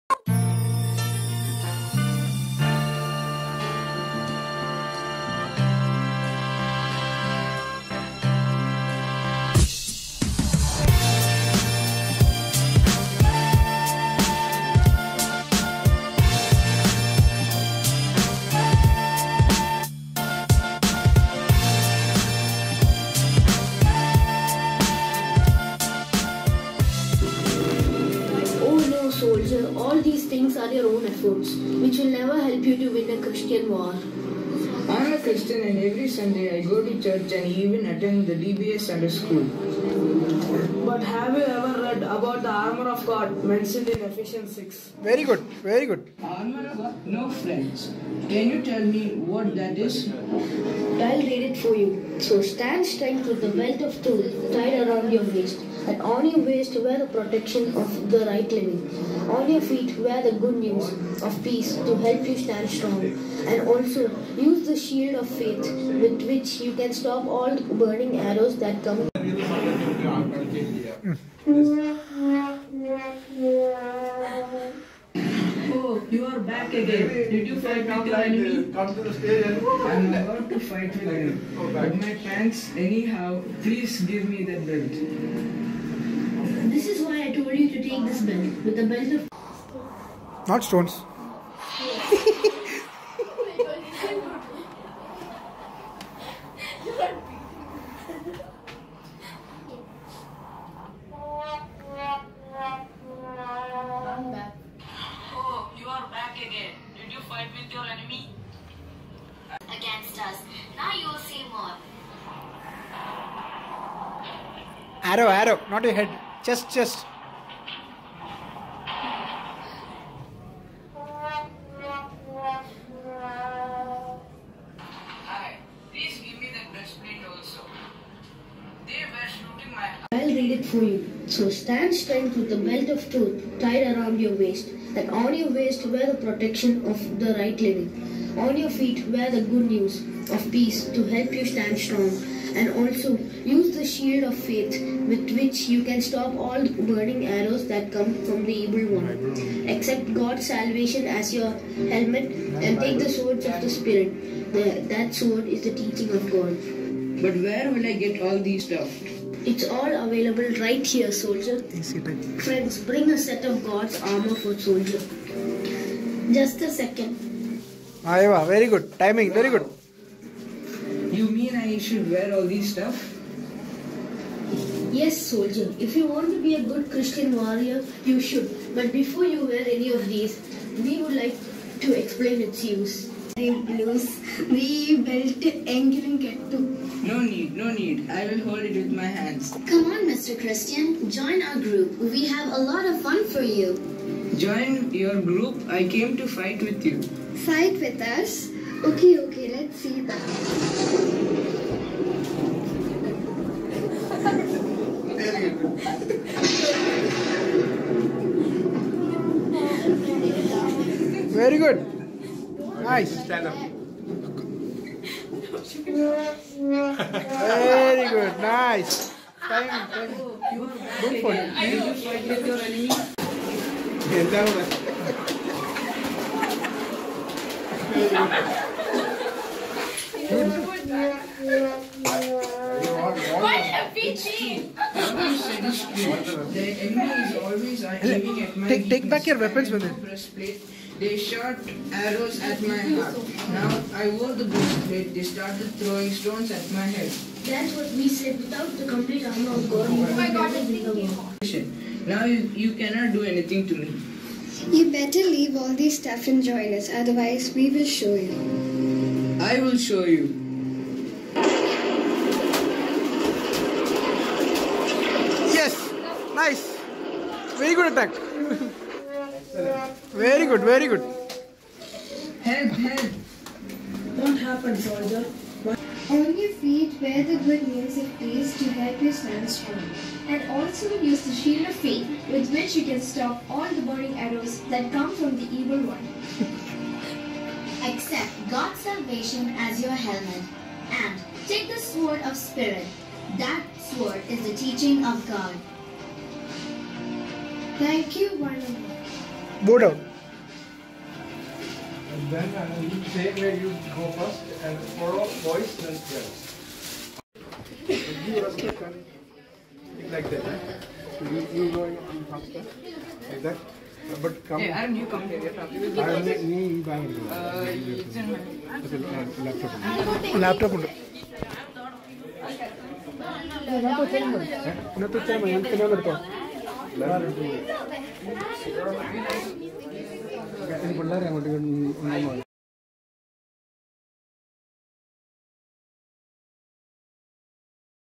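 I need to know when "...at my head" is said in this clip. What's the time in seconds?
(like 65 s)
246 s.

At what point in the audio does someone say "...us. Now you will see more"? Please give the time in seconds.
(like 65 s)
110 s.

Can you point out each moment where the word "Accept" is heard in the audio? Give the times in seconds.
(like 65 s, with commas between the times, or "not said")
149 s, 287 s.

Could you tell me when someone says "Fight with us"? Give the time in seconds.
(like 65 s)
197 s.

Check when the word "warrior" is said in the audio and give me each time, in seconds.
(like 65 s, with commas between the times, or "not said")
177 s.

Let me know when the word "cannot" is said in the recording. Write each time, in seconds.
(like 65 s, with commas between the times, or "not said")
252 s.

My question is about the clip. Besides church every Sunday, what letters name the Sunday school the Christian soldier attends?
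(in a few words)
DBA.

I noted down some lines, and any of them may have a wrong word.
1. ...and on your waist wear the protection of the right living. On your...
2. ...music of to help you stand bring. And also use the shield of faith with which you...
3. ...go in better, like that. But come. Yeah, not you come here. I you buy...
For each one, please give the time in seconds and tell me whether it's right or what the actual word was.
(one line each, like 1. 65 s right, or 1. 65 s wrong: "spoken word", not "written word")
1. 55 s right
2. 277 s wrong: "strong", not "bring"
3. 311 s wrong: "faster", not "better".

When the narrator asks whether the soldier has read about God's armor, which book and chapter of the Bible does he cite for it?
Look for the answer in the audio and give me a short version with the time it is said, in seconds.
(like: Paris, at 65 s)
Ephesians 6, at 44 s.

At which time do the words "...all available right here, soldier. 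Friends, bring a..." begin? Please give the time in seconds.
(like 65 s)
159 s.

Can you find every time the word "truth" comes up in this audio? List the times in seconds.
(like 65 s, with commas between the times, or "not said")
54 s, 133 s.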